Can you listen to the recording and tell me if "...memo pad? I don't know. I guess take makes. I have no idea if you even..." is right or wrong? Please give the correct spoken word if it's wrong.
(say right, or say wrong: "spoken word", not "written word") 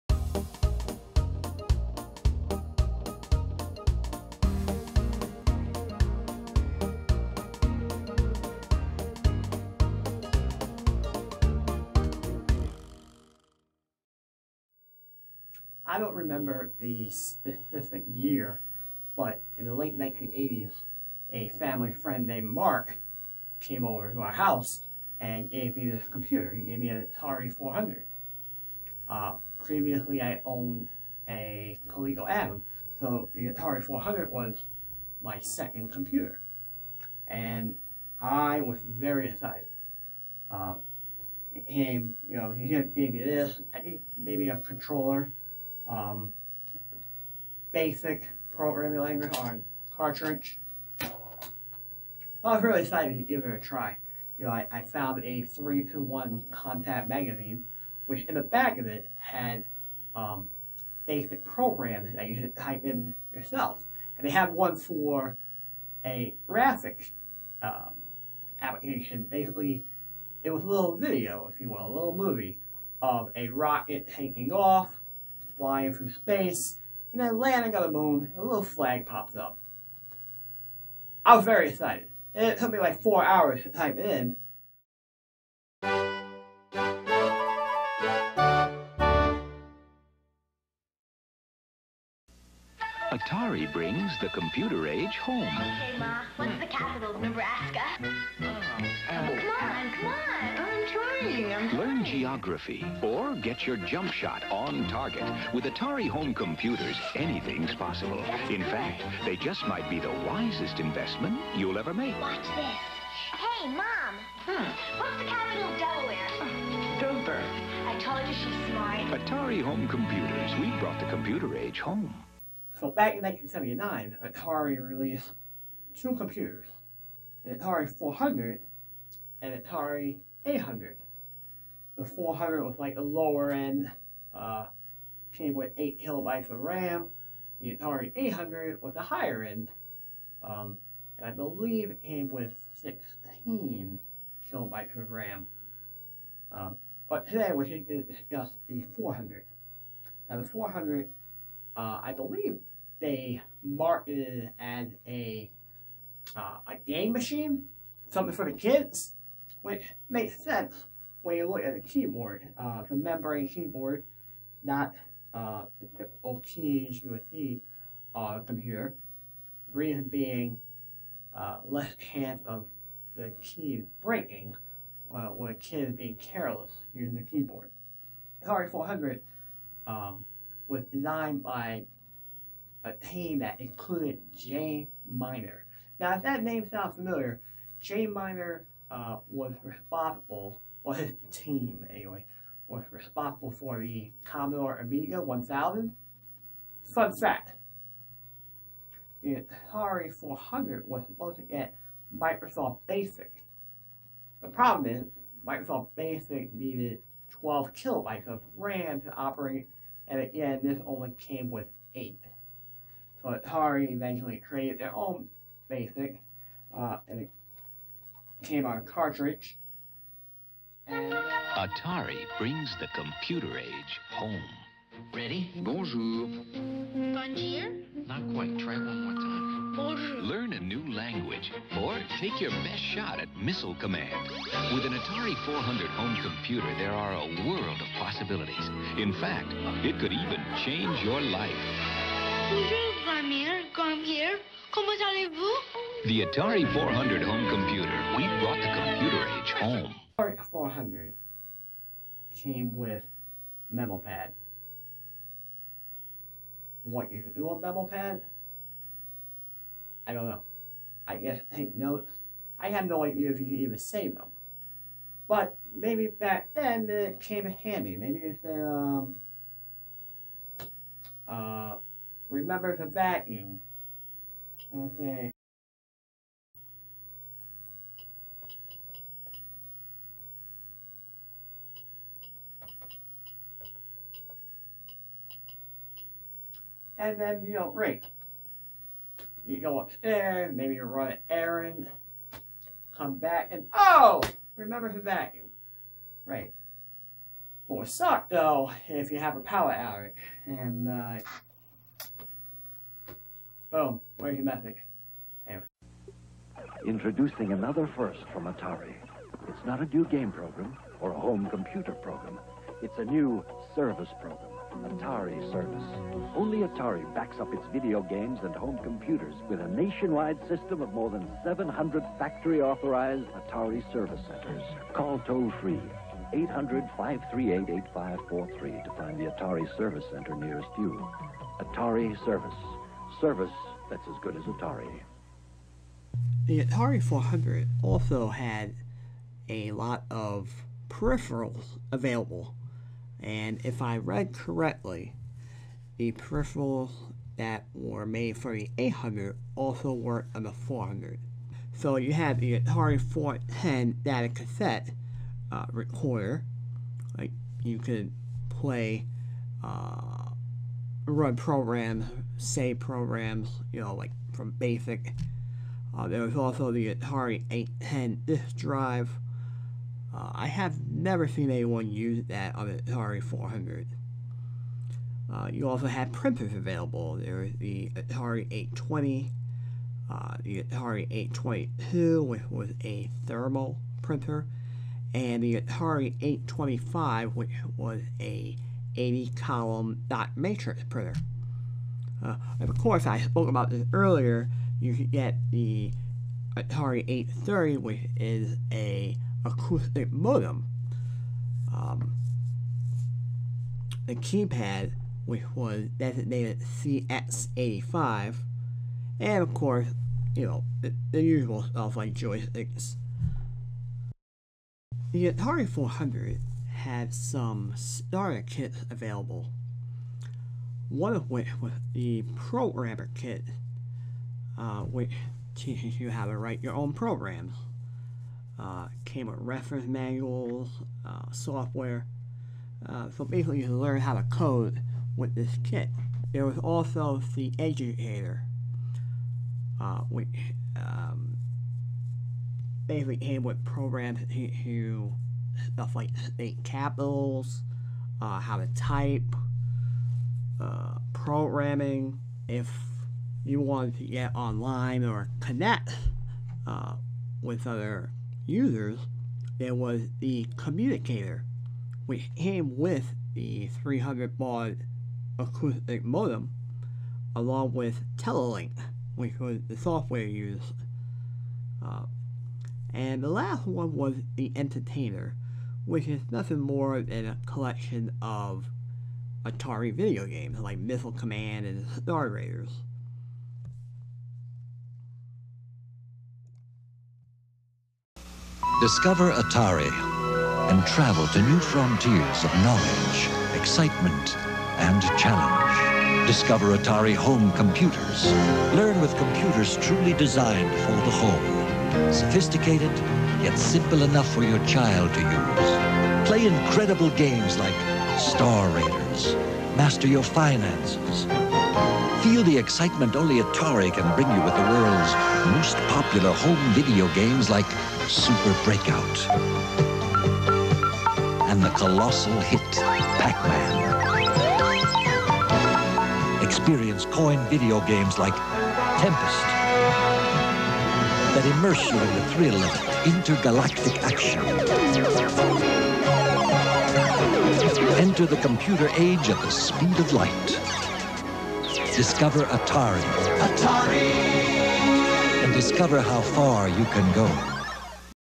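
wrong: "notes", not "makes".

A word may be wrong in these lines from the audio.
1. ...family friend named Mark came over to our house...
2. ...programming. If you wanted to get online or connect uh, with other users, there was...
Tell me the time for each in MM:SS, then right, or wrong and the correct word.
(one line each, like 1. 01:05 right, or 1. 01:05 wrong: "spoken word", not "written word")
1. 00:21 right
2. 07:31 right.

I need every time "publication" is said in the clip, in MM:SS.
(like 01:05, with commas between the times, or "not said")
not said.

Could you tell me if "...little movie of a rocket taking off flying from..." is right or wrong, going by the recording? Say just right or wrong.
right.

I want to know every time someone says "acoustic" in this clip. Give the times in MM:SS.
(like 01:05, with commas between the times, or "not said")
06:39, 07:45.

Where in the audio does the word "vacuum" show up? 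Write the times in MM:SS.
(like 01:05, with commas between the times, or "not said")
04:32, 04:55.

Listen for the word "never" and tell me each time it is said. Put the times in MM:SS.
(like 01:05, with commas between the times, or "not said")
06:10.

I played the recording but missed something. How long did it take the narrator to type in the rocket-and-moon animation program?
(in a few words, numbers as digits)
4 hours.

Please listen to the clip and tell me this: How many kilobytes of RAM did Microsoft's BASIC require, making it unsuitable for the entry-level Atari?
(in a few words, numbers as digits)
12.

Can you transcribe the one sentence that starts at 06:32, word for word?
Uh, of course, I spoke about this earlier.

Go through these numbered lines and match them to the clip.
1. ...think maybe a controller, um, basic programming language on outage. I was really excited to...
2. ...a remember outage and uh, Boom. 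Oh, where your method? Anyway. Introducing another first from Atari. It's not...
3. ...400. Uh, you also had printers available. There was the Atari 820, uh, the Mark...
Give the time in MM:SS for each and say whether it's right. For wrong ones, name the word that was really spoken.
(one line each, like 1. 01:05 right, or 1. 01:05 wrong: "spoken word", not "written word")
1. 00:43 wrong: "cartridge", not "outage"
2. 04:59 wrong: "power", not "remember"
3. 06:13 wrong: "Atari", not "Mark".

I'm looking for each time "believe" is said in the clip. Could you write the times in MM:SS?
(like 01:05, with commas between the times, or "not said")
02:21, 02:32.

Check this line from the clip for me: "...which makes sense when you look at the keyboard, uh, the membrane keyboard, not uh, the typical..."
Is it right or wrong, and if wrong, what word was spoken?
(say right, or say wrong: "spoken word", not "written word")
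right.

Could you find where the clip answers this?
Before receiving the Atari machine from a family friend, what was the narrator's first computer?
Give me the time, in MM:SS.
00:31.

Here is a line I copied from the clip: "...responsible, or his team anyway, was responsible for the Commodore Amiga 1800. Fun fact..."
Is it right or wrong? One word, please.
wrong.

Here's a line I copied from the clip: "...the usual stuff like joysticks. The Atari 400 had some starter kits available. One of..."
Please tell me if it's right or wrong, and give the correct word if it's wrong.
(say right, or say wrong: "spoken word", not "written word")
right.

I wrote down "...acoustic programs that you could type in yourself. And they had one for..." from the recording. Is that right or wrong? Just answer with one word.
wrong.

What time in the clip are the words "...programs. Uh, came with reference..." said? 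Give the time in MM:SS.
07:06.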